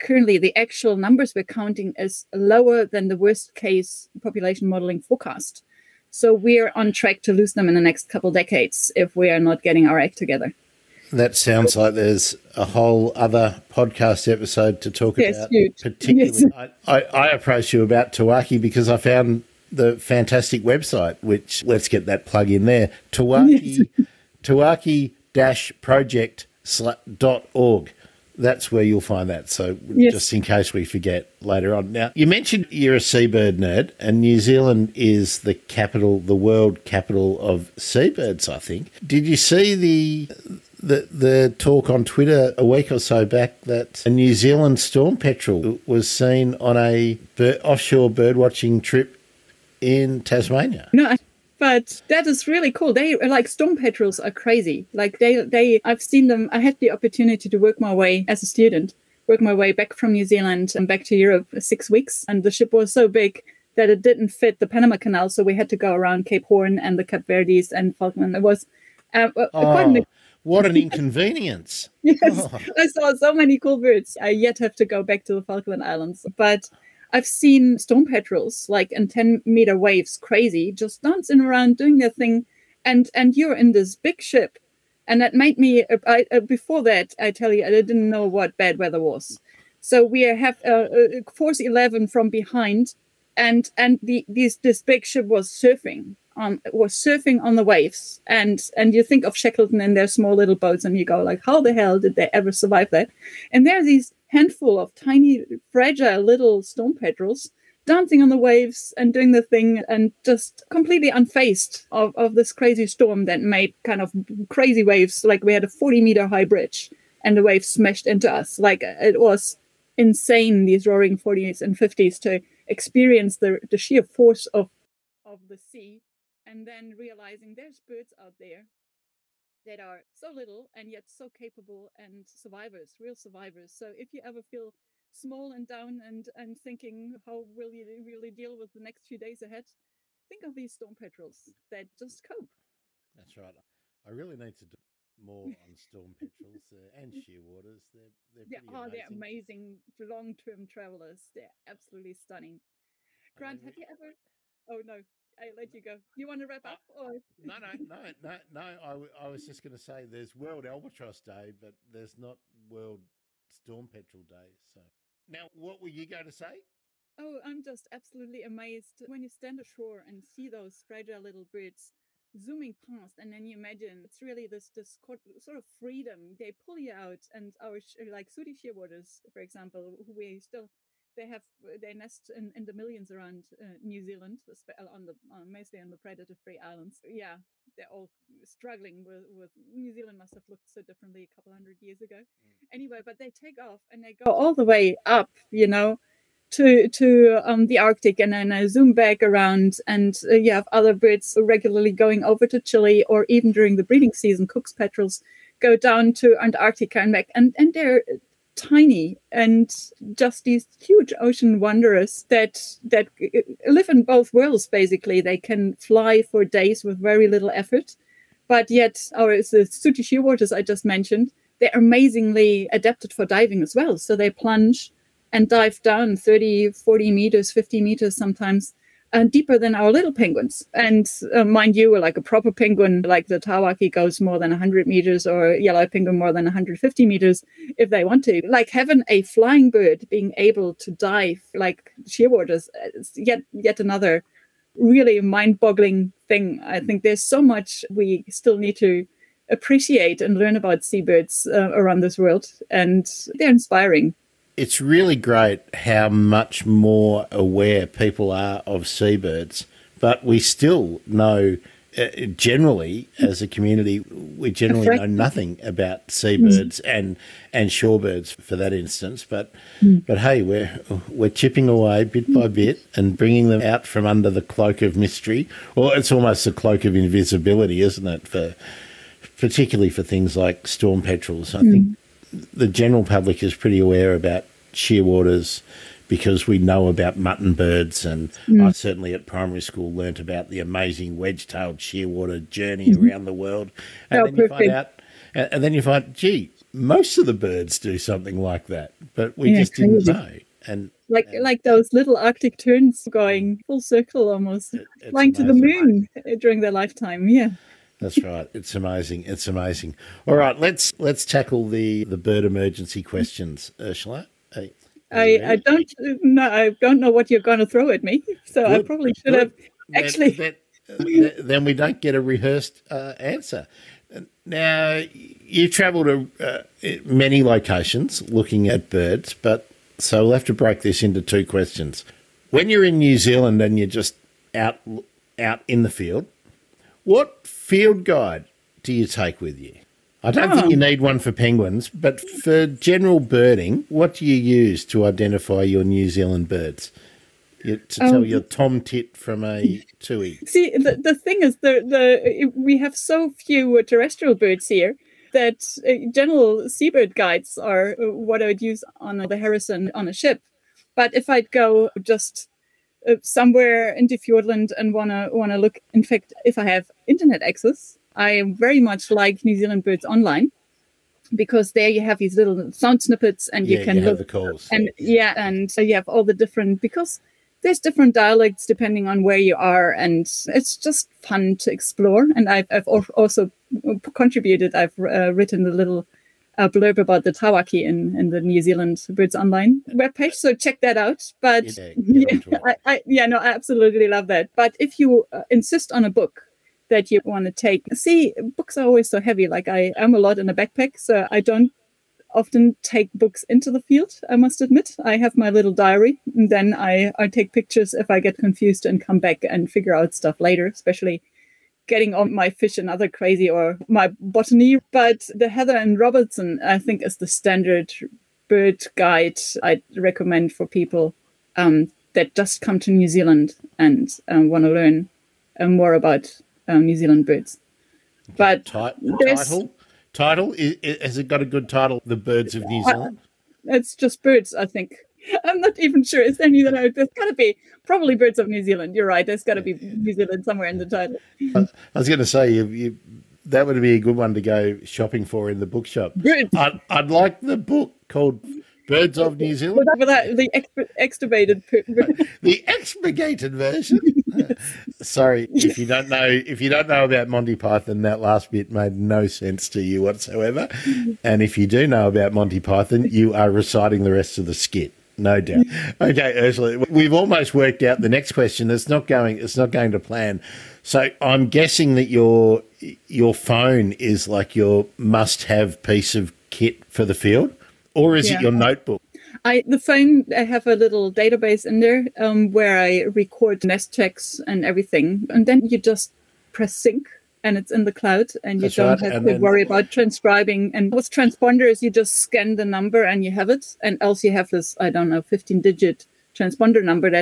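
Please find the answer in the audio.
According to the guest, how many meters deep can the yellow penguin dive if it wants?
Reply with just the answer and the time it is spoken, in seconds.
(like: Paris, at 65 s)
150 meters, at 236 s.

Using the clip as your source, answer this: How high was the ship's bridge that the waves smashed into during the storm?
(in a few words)
40 meters.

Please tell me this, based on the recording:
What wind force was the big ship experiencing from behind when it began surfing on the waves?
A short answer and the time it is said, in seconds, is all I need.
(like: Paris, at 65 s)
Force 11, at 91 s.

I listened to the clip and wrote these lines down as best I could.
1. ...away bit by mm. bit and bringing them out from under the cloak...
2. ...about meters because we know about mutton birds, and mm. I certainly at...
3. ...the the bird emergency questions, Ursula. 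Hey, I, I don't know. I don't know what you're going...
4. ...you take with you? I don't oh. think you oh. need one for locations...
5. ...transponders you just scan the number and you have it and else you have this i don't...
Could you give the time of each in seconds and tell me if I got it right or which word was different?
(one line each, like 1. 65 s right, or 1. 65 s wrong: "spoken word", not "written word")
1. 271 s right
2. 284 s wrong: "shearwaters", not "meters"
3. 311 s right
4. 338 s wrong: "penguins", not "locations"
5. 491 s right.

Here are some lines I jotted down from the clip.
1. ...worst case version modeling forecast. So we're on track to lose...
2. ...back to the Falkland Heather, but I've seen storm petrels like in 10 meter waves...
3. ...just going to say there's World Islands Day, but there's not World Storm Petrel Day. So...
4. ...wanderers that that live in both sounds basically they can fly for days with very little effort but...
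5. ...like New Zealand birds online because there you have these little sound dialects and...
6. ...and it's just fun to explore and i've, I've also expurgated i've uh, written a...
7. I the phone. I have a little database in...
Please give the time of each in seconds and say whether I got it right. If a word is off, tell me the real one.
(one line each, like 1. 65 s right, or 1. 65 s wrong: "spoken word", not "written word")
1. 3 s wrong: "population", not "version"
2. 75 s wrong: "Islands", not "Heather"
3. 159 s wrong: "Albatross", not "Islands"
4. 211 s wrong: "worlds", not "sounds"
5. 369 s wrong: "snippets", not "dialects"
6. 379 s wrong: "contributed", not "expurgated"
7. 479 s right.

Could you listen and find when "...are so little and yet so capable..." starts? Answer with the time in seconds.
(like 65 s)
129 s.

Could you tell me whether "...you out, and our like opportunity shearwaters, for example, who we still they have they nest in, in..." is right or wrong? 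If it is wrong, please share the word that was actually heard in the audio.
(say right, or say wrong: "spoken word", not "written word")
wrong: "sooty", not "opportunity".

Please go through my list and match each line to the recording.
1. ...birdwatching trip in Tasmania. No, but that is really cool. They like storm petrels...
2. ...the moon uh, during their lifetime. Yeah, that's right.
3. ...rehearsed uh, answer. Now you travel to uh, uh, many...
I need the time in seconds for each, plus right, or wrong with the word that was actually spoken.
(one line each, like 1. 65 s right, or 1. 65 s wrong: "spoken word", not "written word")
1. 48 s right
2. 305 s right
3. 322 s right.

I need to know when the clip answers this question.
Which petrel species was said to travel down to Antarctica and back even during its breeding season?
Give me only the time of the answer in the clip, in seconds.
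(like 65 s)
204 s.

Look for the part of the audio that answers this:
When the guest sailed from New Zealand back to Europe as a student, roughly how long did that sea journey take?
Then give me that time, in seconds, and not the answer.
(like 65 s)
61 s.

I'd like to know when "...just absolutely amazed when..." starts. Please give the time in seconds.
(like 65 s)
167 s.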